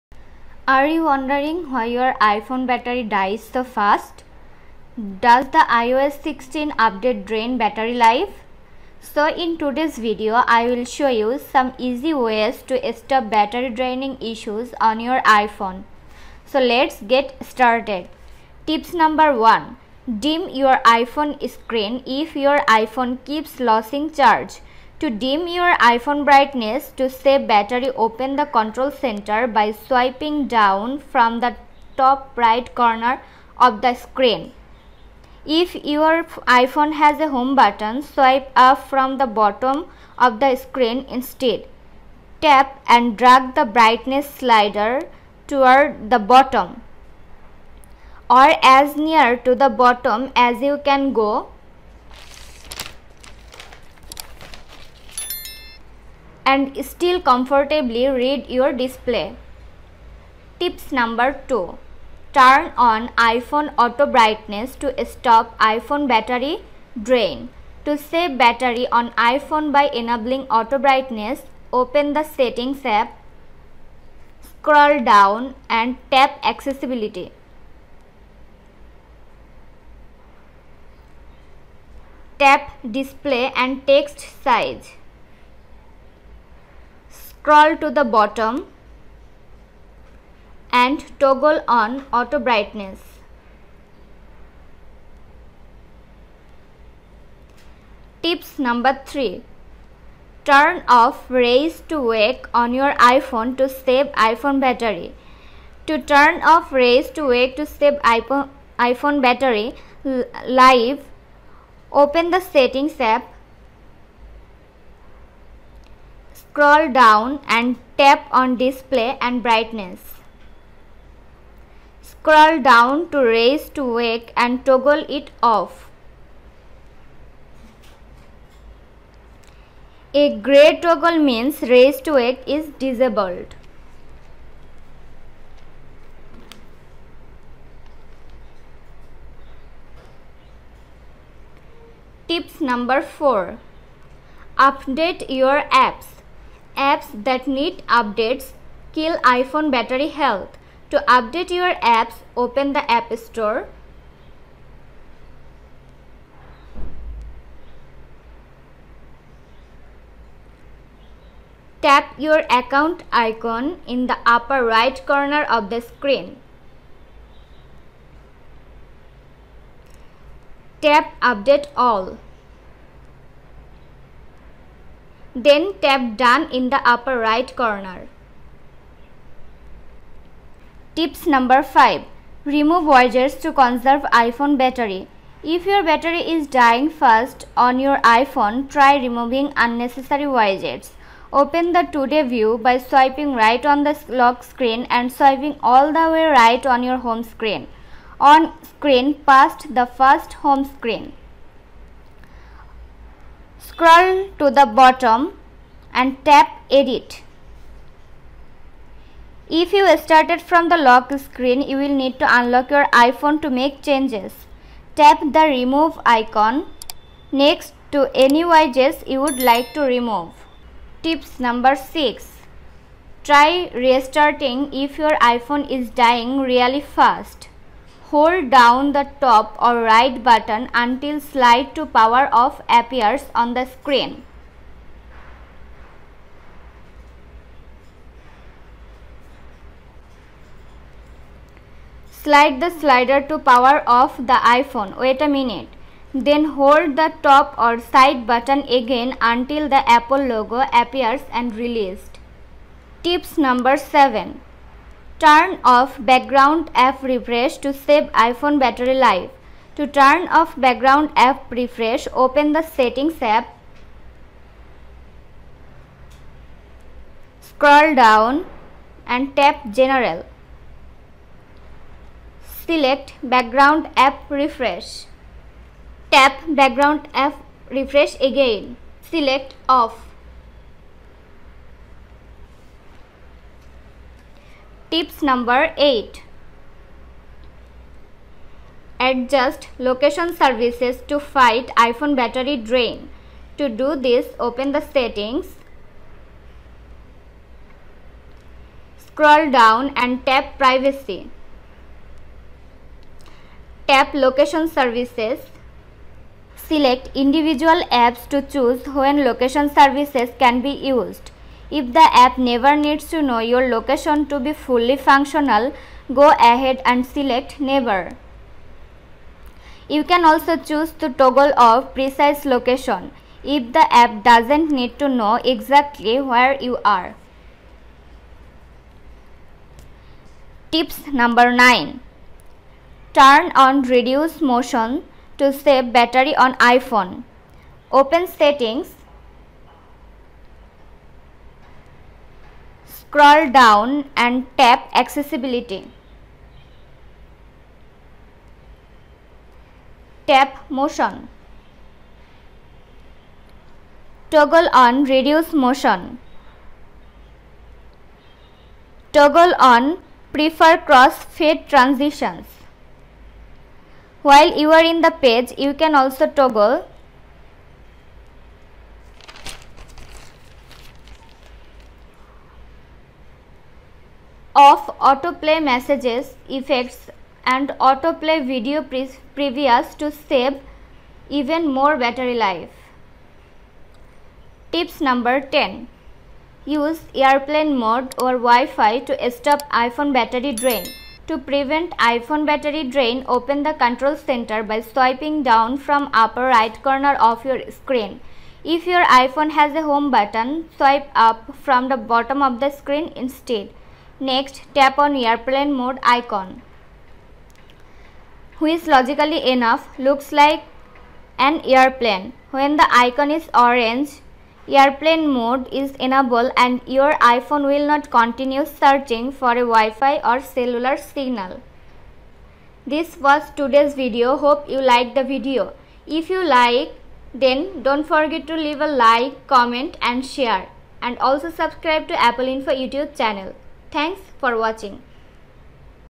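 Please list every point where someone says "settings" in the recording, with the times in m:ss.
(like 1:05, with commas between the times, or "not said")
1:12, 1:52, 4:22, 4:54, 5:38.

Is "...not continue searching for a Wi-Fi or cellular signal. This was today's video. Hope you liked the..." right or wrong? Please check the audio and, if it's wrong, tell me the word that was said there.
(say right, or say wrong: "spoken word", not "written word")
right.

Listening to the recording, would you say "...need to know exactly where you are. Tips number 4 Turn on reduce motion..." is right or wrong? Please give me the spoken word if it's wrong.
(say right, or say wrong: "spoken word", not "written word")
wrong: "9", not "4".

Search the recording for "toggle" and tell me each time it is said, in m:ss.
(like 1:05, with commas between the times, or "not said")
1:31, 2:04, 2:10, 5:21, 5:54, 5:59, 6:06.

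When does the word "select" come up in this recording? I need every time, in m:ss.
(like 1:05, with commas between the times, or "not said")
4:32, 4:39, 5:06, 5:17.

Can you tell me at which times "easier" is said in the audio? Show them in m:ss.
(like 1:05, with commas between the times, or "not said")
not said.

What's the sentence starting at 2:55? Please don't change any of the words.
Then tap done in the upper right corner.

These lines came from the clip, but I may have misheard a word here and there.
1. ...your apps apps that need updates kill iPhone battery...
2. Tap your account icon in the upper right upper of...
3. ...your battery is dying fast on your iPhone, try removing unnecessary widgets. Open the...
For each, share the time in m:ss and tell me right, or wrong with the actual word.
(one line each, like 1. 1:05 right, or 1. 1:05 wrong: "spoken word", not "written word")
1. 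2:25 right
2. 2:41 wrong: "corner", not "upper"
3. 3:05 right.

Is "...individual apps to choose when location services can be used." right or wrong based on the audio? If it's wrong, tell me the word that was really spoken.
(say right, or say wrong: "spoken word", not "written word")
right.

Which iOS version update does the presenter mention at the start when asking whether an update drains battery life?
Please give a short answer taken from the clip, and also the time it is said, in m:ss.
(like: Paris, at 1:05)
iOS 16, at 0:05.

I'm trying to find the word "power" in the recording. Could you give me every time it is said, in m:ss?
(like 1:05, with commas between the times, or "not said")
3:51, 4:03.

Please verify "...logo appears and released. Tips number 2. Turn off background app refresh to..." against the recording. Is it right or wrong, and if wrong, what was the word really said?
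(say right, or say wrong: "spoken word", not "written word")
wrong: "7", not "2".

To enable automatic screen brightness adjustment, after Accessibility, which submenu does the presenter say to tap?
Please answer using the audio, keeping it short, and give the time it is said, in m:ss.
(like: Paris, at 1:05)
Display and text size, at 1:22.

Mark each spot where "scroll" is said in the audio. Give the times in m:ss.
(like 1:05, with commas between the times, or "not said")
1:14, 1:27, 1:56, 2:02, 3:23, 4:27, 4:59, 5:43.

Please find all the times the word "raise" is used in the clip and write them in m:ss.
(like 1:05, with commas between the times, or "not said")
1:41, 1:46, 2:03, 2:11.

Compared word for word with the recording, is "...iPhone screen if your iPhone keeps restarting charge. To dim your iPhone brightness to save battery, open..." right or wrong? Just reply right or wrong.
wrong.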